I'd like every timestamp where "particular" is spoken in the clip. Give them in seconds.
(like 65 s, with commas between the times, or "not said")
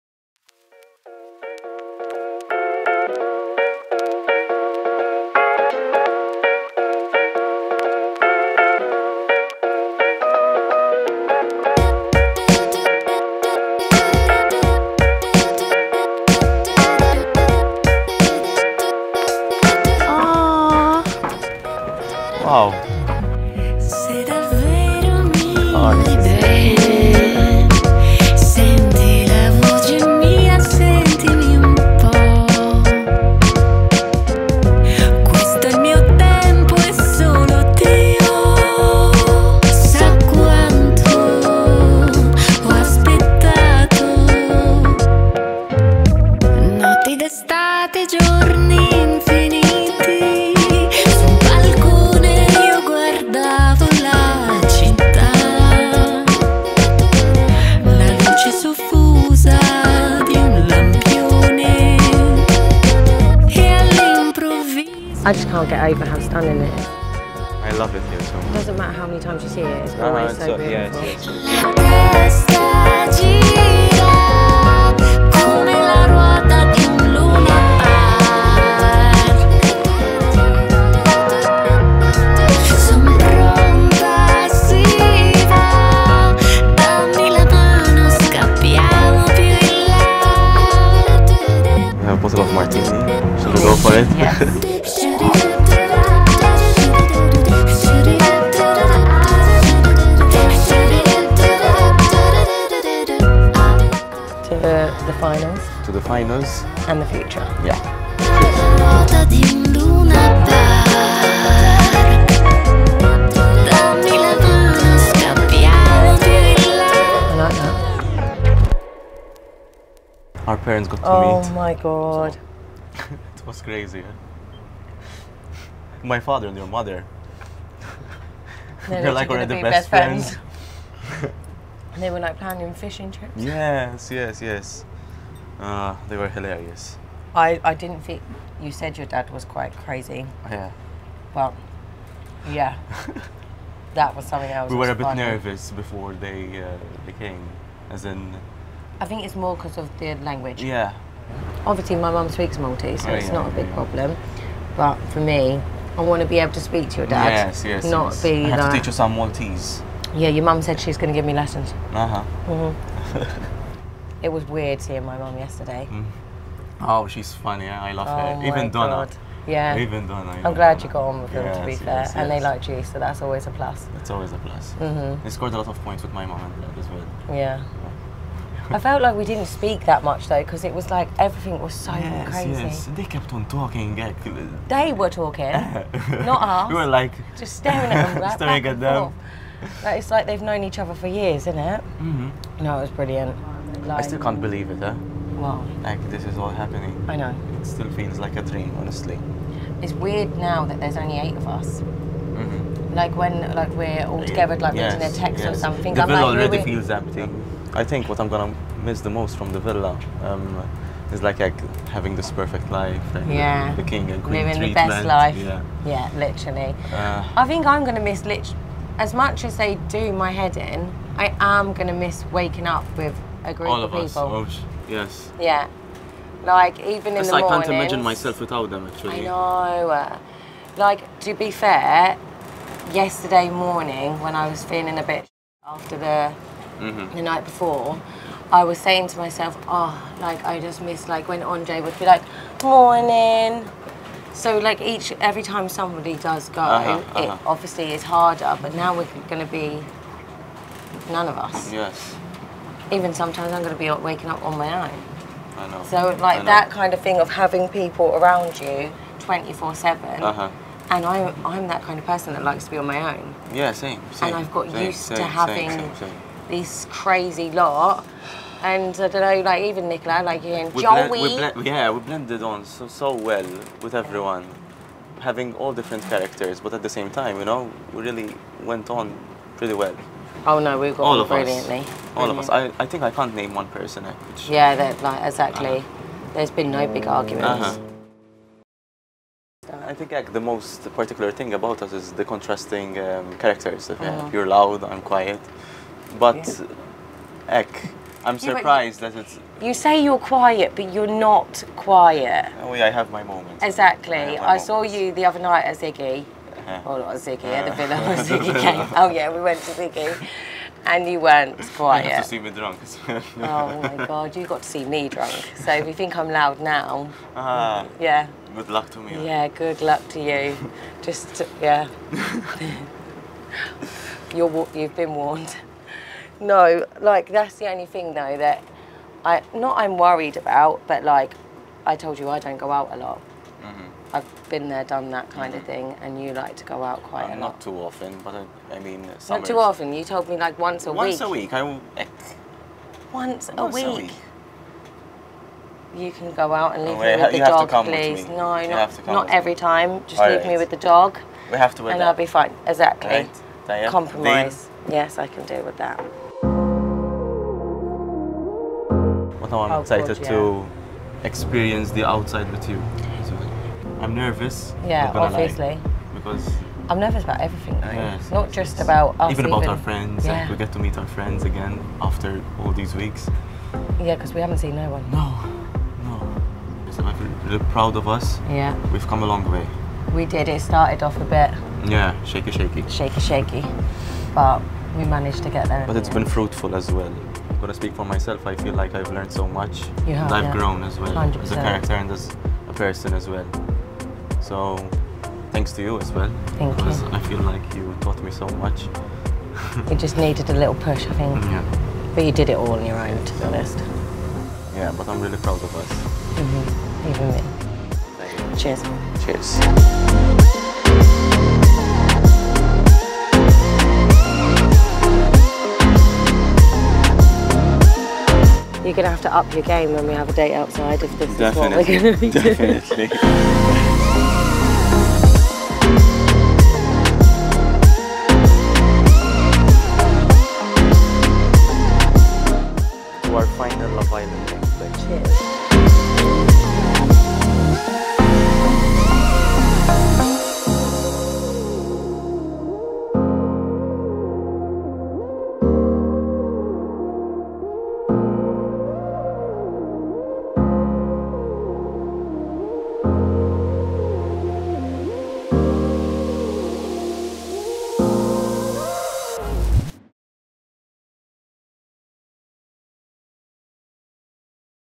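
290 s.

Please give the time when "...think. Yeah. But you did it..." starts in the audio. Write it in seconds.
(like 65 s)
401 s.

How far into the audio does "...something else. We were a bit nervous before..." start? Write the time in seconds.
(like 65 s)
144 s.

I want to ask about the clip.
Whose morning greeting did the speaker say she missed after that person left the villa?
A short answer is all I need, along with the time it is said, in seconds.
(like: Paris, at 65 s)
Andre, at 241 s.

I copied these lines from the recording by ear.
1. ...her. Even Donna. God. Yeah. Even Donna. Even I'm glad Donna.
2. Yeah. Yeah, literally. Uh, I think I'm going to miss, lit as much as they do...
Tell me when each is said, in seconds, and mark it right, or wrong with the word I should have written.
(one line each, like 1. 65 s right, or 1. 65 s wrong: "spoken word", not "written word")
1. 168 s right
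2. 215 s right.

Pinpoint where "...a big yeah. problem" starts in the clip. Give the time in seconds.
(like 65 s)
153 s.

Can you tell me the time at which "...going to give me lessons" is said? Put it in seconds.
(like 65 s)
160 s.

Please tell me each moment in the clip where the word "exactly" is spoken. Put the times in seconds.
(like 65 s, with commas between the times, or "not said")
285 s, 303 s, 352 s.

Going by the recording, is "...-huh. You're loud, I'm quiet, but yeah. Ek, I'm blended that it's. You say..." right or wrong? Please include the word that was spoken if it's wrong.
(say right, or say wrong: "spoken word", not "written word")
wrong: "surprised", not "blended".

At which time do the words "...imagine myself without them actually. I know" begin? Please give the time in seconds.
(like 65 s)
227 s.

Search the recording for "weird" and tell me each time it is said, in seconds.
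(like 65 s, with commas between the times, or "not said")
164 s, 199 s.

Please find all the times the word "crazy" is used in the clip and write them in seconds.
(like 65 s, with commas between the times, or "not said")
123 s, 139 s, 182 s, 266 s.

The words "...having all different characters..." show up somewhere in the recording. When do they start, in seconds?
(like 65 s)
275 s.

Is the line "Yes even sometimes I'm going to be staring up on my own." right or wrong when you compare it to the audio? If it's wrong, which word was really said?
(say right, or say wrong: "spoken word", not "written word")
wrong: "waking", not "staring".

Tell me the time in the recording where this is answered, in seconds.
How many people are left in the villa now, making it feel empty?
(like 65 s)
201 s.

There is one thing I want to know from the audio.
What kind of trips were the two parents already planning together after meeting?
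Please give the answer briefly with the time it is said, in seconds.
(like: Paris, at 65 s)
fishing trips, at 132 s.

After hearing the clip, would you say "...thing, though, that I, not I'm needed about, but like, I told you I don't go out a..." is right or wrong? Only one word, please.
wrong.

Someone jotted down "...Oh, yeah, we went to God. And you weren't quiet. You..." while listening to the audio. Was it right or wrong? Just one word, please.
wrong.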